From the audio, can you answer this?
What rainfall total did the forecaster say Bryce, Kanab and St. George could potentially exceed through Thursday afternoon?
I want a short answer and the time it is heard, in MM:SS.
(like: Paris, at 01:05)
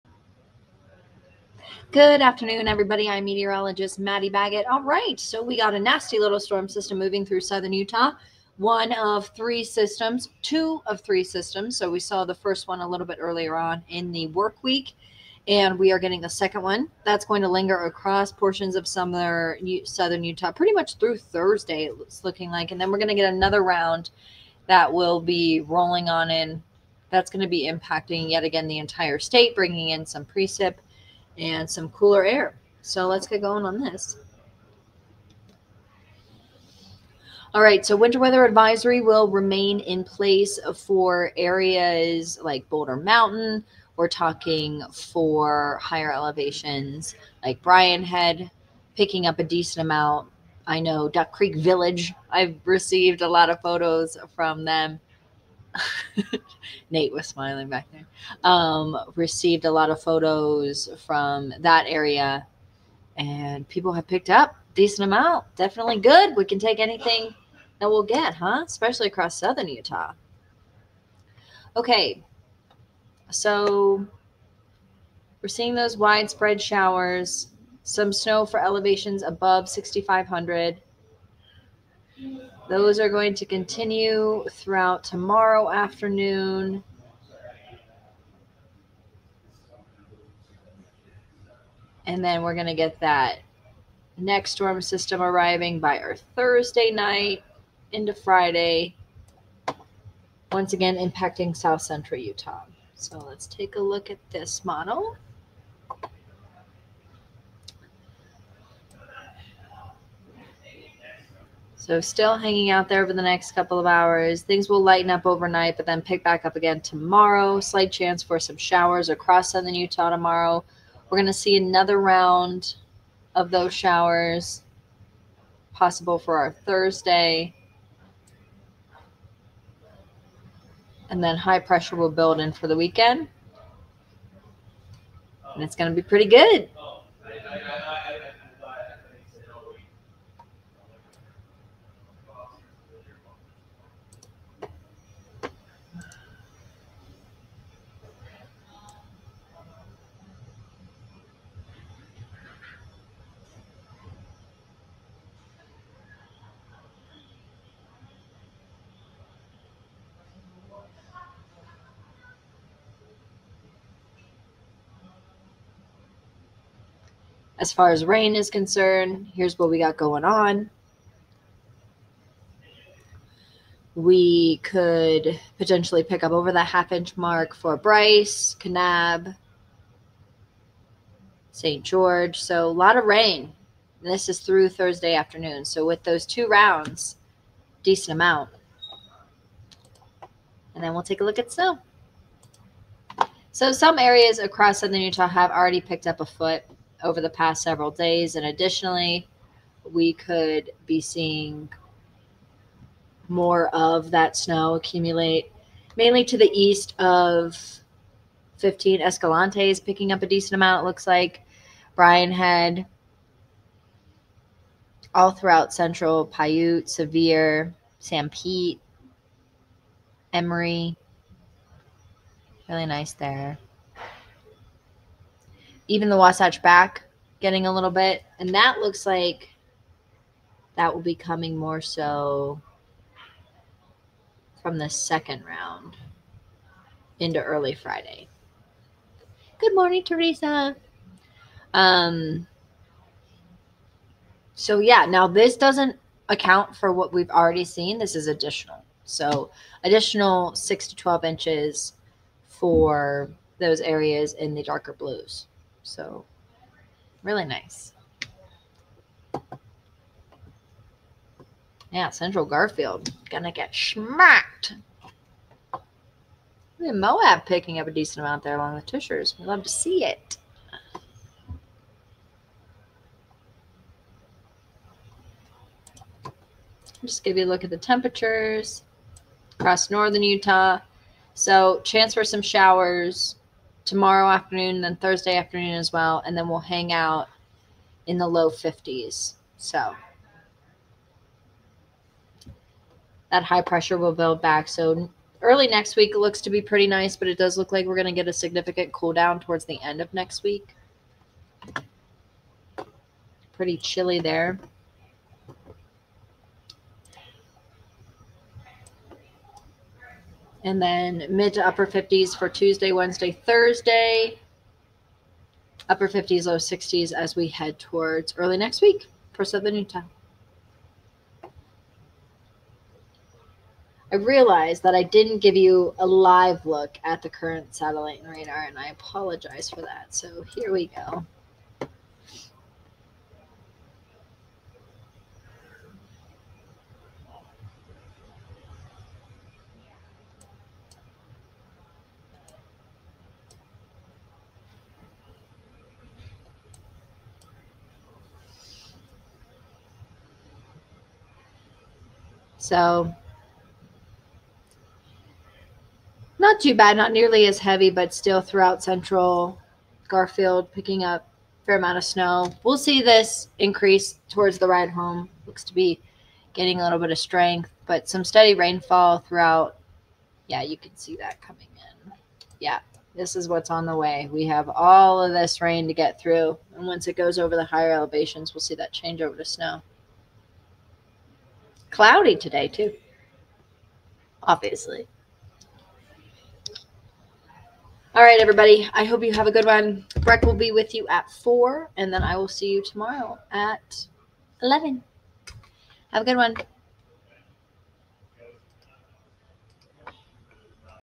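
half inch, at 02:56.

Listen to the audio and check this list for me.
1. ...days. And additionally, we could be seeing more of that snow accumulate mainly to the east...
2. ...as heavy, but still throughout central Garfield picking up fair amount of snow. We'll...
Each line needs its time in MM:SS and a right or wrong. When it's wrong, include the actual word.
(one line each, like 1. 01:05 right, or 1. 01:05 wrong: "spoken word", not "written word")
1. 03:17 right
2. 05:57 right.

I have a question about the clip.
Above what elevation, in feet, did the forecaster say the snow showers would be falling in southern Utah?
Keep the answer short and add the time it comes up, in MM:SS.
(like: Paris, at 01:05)
6,500, at 01:19.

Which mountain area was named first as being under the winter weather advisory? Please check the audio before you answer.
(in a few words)
Boulder Mountain.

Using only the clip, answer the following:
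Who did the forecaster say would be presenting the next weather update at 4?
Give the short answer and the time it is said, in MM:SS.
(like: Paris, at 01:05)
Breck, at 06:30.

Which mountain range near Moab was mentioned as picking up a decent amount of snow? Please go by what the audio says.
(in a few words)
Tushars.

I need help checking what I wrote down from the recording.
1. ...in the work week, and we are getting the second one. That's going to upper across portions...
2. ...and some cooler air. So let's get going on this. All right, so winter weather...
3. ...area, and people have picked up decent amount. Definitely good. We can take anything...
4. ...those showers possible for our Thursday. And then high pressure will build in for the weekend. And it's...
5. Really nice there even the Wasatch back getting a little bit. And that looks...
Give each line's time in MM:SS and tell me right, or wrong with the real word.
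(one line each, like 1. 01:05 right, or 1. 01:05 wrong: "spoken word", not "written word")
1. 00:13 wrong: "linger", not "upper"
2. 00:31 right
3. 01:01 right
4. 02:03 right
5. 03:42 right.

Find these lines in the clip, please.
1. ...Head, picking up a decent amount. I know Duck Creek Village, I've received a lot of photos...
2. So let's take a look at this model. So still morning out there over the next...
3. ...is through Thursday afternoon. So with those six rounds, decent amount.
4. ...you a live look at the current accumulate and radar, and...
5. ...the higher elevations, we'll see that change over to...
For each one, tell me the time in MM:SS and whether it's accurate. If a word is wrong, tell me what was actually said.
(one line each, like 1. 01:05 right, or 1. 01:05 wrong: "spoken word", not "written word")
1. 00:48 right
2. 01:42 wrong: "hanging", not "morning"
3. 03:04 wrong: "two", not "six"
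4. 05:25 wrong: "satellite", not "accumulate"
5. 06:17 right.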